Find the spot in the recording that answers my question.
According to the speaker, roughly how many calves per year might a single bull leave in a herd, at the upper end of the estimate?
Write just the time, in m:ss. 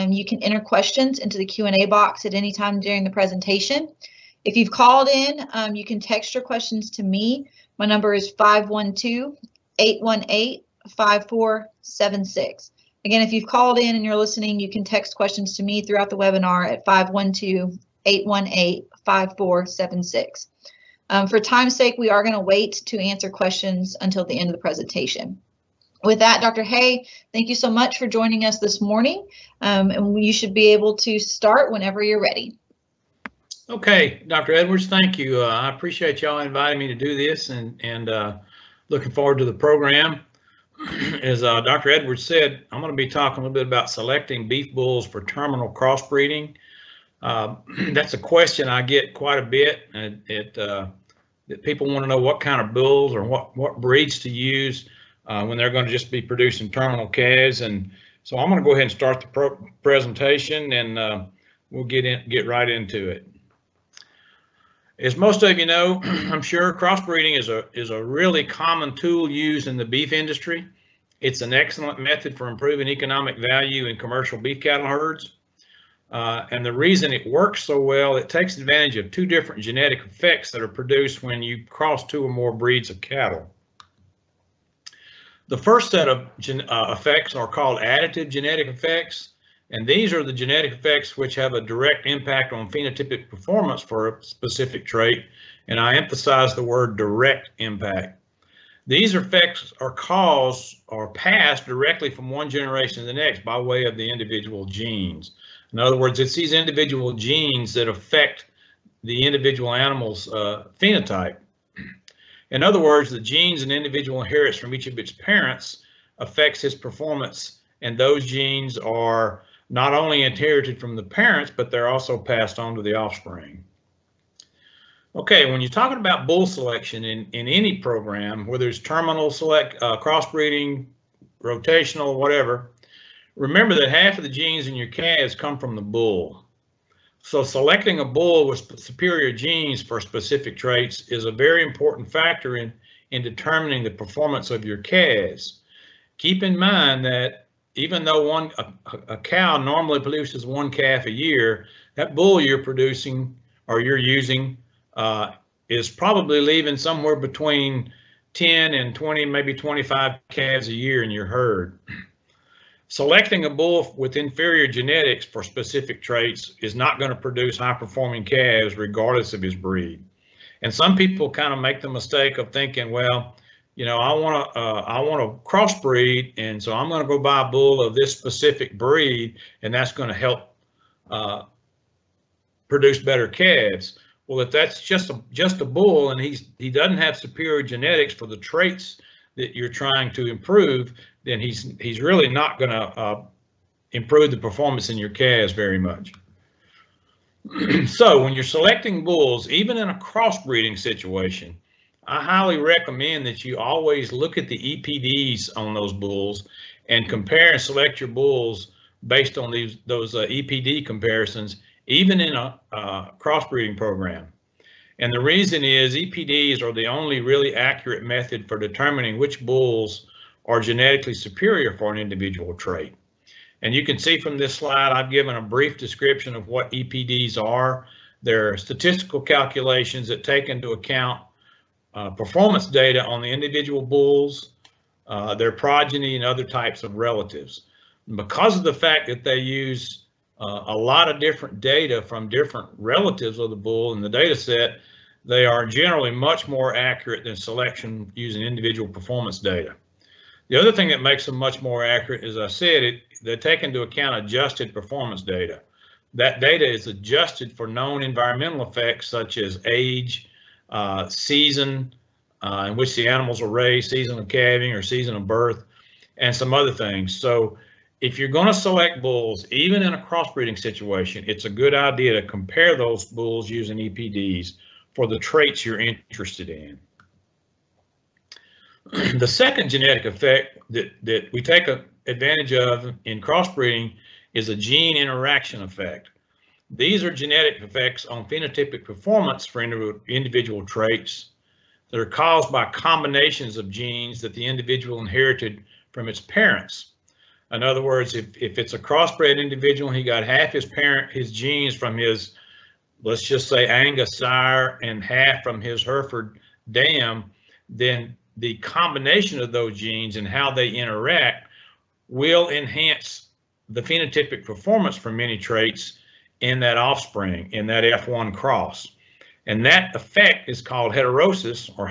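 2:39.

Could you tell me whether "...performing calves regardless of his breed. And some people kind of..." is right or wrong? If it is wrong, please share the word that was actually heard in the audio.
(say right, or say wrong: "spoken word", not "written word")
right.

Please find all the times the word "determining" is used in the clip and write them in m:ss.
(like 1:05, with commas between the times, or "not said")
2:23, 3:38.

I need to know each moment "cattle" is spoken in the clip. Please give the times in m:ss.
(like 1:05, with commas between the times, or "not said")
1:14, 1:22.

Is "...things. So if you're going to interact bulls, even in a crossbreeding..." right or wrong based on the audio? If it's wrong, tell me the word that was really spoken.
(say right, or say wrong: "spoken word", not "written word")
wrong: "select", not "interact".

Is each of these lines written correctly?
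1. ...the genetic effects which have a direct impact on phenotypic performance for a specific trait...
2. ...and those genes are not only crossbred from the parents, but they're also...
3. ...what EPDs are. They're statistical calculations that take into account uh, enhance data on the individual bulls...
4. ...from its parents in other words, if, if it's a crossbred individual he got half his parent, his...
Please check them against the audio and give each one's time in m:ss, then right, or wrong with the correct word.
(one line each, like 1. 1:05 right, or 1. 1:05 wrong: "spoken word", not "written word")
1. 1:30 right
2. 1:57 wrong: "inherited", not "crossbred"
3. 3:46 wrong: "performance", not "enhance"
4. 4:55 right.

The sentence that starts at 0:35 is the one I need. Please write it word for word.
Uh, I appreciate y'all inviting me to do this and, and uh, looking forward to the program.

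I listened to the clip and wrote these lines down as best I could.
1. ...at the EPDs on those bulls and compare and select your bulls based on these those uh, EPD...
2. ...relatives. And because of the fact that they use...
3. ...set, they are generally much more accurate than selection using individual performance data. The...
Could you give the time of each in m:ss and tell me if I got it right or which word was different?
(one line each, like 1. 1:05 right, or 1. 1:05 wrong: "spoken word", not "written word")
1. 3:24 right
2. 3:56 right
3. 4:04 right.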